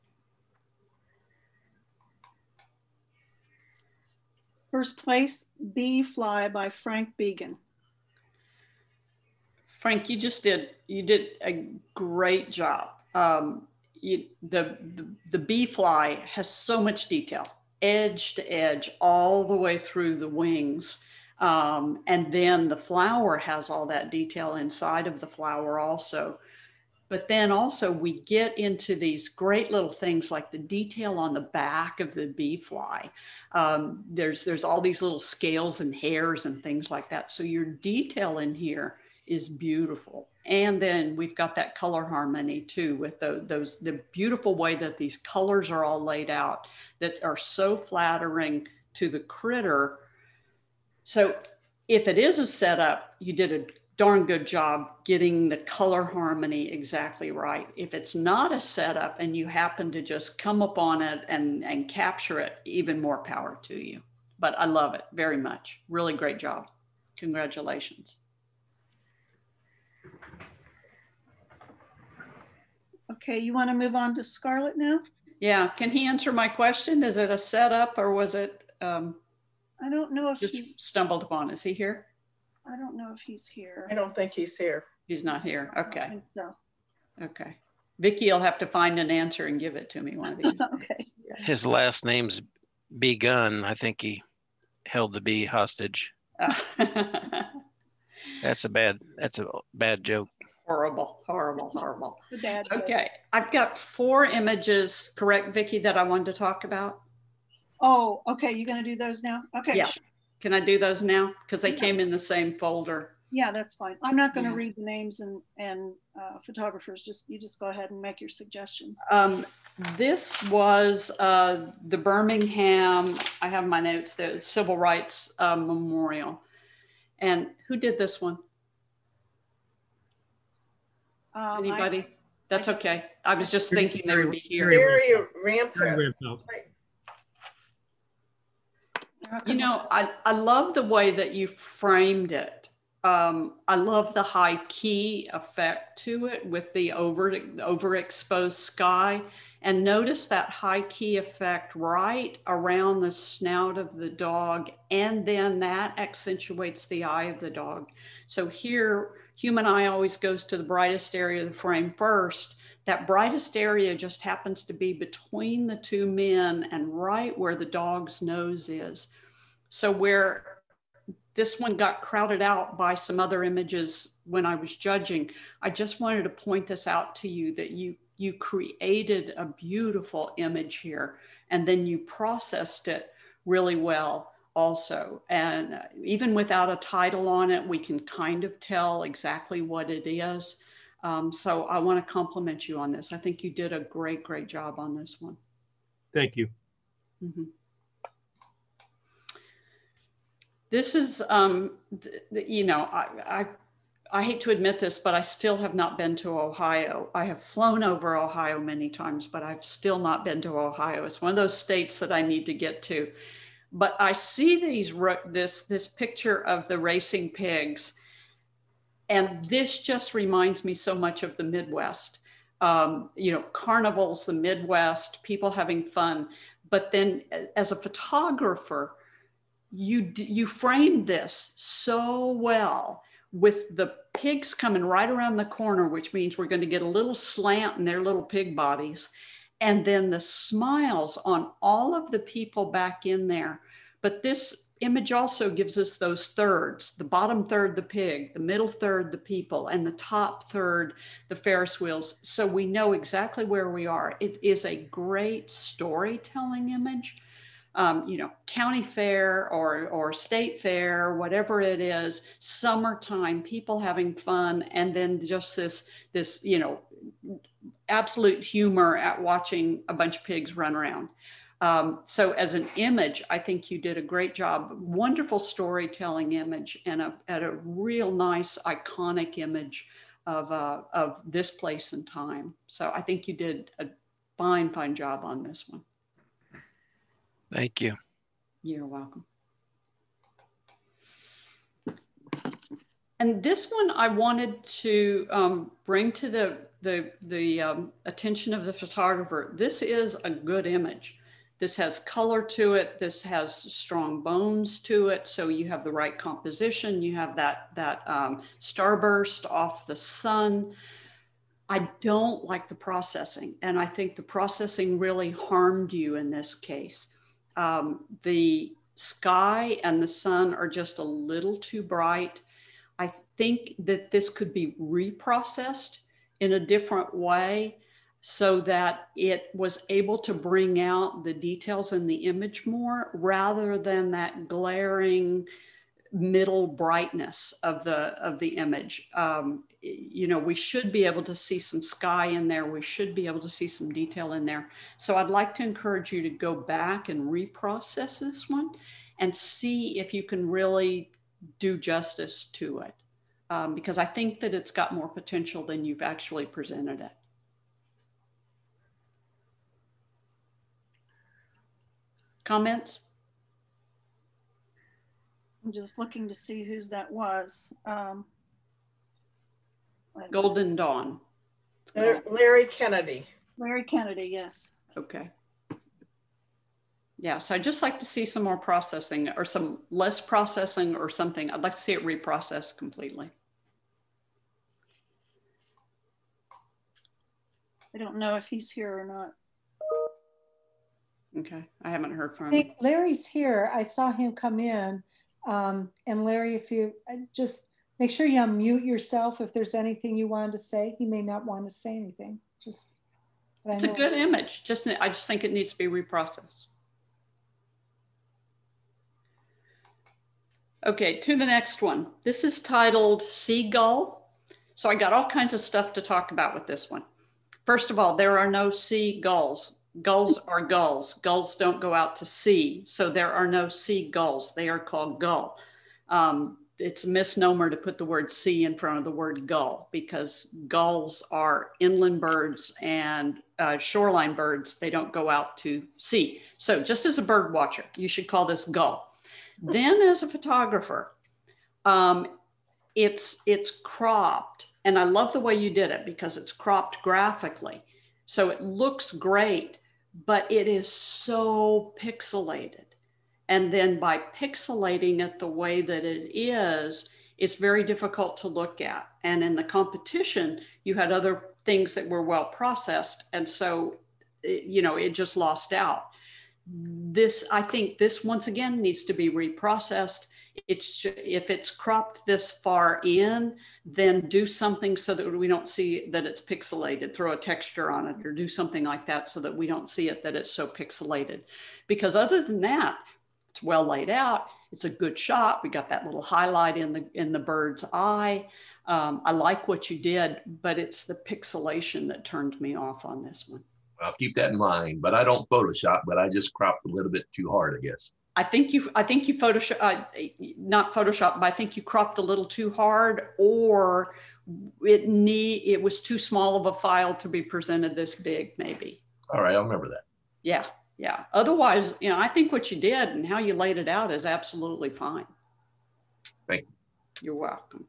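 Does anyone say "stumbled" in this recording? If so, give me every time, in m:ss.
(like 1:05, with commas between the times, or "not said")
1:20.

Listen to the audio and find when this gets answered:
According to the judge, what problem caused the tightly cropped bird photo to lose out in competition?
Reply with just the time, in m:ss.
8:11.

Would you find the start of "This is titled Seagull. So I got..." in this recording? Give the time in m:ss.
6:52.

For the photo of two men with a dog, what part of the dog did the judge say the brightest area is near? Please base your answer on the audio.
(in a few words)
nose.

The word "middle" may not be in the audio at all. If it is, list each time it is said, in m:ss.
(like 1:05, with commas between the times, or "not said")
4:08, 5:36.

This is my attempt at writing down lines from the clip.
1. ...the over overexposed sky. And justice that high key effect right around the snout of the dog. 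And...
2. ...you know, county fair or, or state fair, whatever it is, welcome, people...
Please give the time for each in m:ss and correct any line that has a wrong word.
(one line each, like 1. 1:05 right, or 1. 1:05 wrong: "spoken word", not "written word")
1. 2:26 wrong: "notice", not "justice"
2. 4:18 wrong: "summertime", not "welcome".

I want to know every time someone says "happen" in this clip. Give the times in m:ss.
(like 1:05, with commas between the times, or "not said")
0:59, 2:44.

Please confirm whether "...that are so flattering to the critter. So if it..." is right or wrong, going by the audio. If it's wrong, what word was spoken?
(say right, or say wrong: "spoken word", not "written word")
right.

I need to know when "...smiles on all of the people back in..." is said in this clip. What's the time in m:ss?
4:00.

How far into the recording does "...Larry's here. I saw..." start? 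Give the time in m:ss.
6:32.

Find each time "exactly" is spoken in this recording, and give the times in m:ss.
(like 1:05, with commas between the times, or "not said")
0:56, 3:09, 4:12.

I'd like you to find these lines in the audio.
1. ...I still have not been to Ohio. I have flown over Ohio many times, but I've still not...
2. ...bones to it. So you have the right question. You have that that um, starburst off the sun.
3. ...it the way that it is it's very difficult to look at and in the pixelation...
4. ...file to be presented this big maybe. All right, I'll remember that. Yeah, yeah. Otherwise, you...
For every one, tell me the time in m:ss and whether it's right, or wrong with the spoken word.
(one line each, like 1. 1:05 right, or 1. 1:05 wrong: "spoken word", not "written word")
1. 3:25 right
2. 5:04 wrong: "composition", not "question"
3. 7:35 wrong: "competition", not "pixelation"
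4. 8:26 right.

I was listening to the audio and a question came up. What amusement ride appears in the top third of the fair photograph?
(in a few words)
Ferris wheels.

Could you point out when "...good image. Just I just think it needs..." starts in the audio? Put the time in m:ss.
6:43.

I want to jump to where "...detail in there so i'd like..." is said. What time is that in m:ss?
5:43.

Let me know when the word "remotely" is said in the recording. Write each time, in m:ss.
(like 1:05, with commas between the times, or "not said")
not said.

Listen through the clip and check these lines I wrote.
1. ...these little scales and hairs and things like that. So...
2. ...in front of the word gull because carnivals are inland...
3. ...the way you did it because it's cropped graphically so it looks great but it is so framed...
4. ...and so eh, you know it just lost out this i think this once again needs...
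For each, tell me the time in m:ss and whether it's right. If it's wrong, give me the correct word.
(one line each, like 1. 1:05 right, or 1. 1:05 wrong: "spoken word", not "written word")
1. 0:34 right
2. 7:08 wrong: "gulls", not "carnivals"
3. 7:25 wrong: "pixelated", not "framed"
4. 7:43 right.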